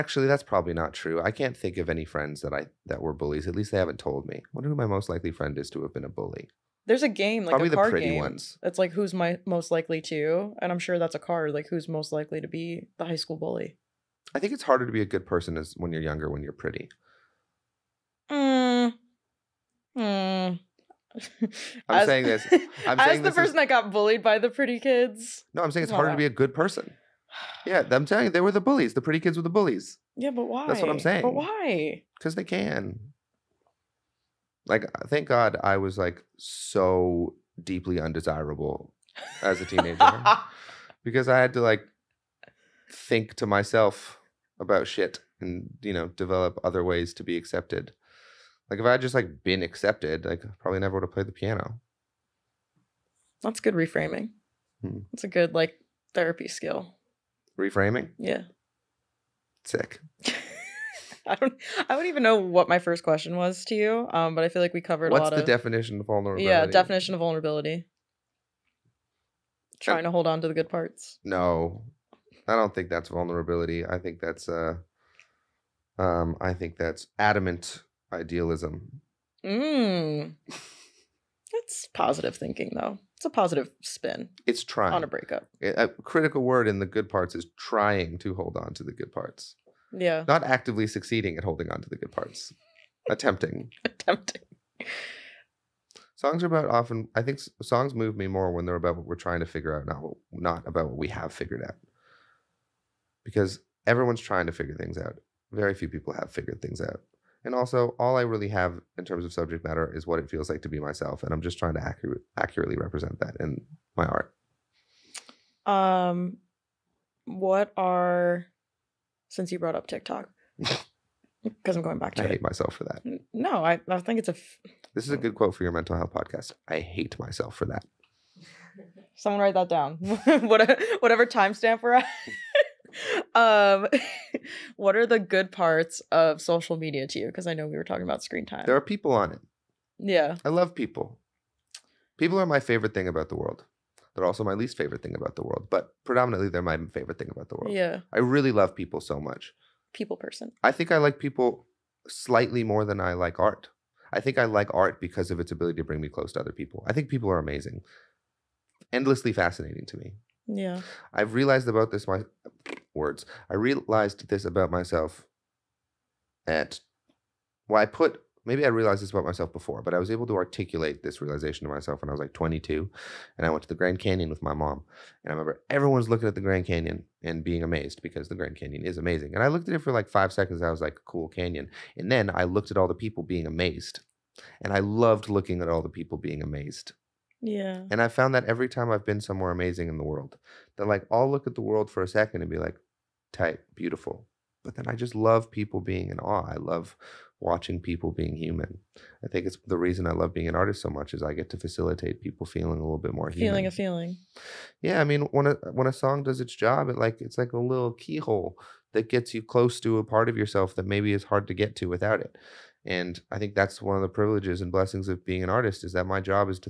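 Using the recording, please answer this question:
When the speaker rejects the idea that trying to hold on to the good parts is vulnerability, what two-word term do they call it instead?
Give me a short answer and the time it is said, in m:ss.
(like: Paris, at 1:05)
adamant idealism, at 1:17.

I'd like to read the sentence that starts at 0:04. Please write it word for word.
I wonder who my most likely friend is to have been a bully.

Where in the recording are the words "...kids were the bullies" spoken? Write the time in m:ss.
0:29.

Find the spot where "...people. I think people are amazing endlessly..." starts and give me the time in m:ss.
2:36.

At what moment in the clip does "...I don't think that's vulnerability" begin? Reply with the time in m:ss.
1:12.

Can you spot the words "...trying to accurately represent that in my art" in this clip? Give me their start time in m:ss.
1:51.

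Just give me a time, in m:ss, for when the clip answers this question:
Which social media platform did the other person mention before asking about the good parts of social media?
1:59.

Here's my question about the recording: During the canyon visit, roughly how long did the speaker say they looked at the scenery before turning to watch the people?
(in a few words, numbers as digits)
5 seconds.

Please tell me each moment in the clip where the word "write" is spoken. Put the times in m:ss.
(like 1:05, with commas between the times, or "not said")
2:09.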